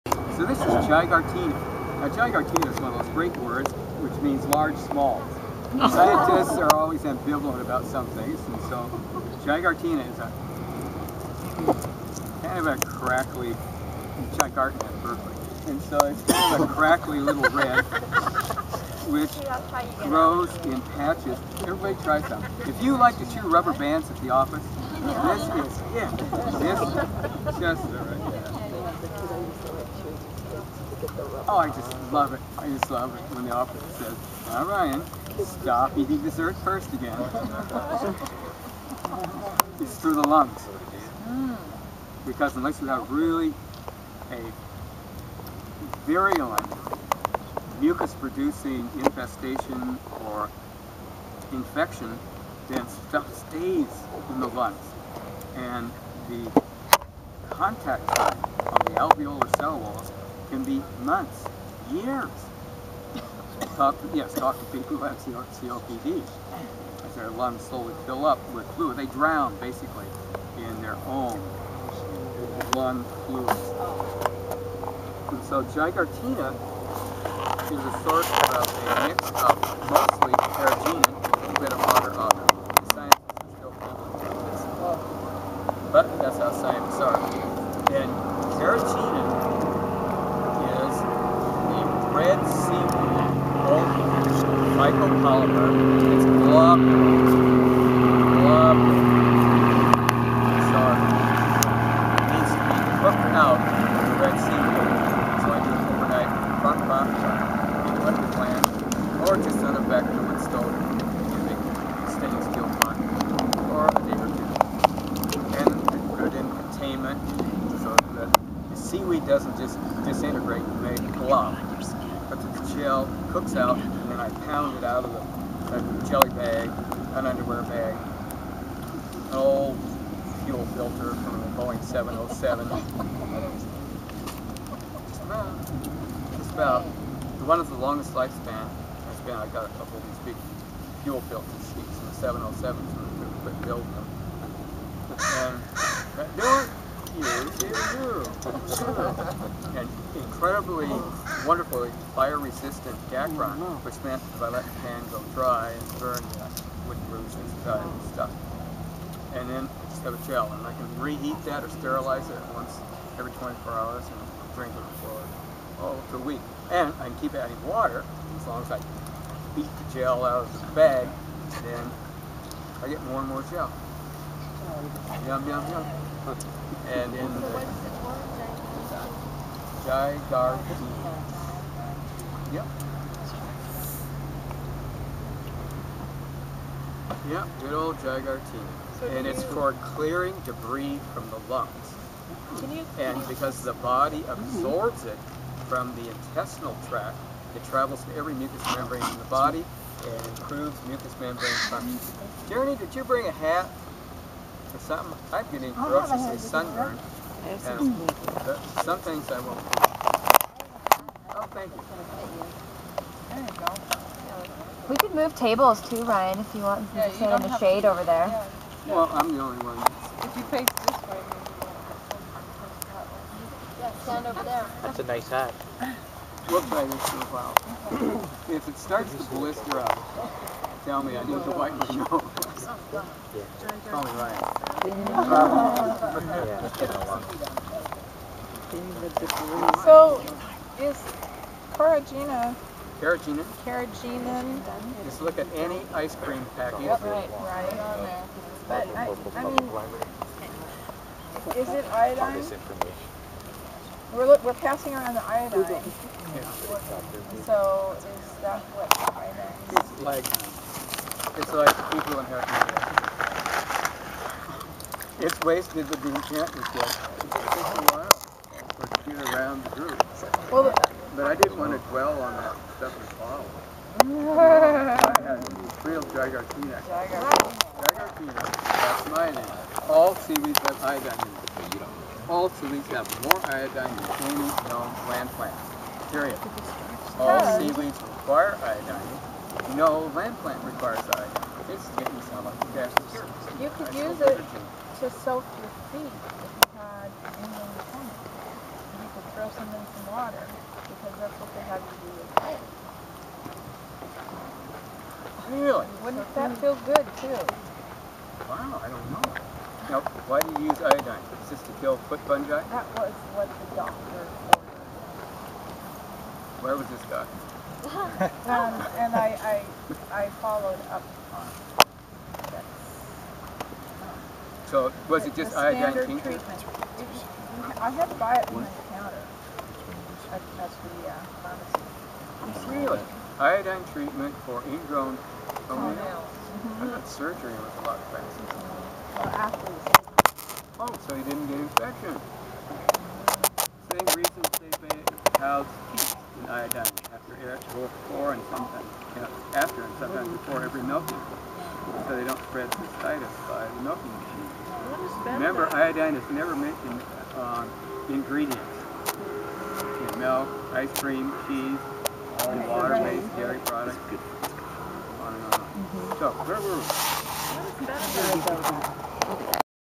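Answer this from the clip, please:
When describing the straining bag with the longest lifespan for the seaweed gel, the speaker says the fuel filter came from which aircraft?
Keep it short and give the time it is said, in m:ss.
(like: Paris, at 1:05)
Boeing 707, at 2:11.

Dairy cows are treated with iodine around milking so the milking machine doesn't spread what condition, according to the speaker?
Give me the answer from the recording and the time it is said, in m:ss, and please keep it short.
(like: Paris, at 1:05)
Cystitis, at 5:52.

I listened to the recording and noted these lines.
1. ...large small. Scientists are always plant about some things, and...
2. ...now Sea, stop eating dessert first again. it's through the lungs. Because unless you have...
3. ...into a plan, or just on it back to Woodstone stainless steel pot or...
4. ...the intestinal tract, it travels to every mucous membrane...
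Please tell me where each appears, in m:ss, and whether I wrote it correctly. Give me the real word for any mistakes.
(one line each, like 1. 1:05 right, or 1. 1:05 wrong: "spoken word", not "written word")
1. 0:04 wrong: "ambivalent", not "plant"
2. 0:34 wrong: "Ryan", not "Sea"
3. 1:48 right
4. 3:15 right.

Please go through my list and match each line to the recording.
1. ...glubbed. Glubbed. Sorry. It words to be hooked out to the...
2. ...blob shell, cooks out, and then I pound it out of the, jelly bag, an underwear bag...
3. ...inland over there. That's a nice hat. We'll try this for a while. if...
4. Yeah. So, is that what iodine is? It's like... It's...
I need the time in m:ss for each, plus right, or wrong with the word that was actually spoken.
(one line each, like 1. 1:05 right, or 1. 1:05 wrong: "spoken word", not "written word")
1. 1:36 wrong: "needs", not "words"
2. 2:01 right
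3. 3:44 wrong: "stand", not "inland"
4. 4:15 right.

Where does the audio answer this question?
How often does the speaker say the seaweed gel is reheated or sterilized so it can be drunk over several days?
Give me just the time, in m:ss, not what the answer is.
2:42.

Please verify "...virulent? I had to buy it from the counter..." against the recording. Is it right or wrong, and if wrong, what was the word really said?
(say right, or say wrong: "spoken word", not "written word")
wrong: "treatment", not "virulent".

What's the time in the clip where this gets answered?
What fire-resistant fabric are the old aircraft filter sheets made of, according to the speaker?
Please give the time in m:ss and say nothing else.
2:33.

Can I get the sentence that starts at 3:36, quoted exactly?
Yeah, you sit in the shade over there.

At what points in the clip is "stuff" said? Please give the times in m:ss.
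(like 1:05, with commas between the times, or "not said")
0:53, 2:38, 4:32.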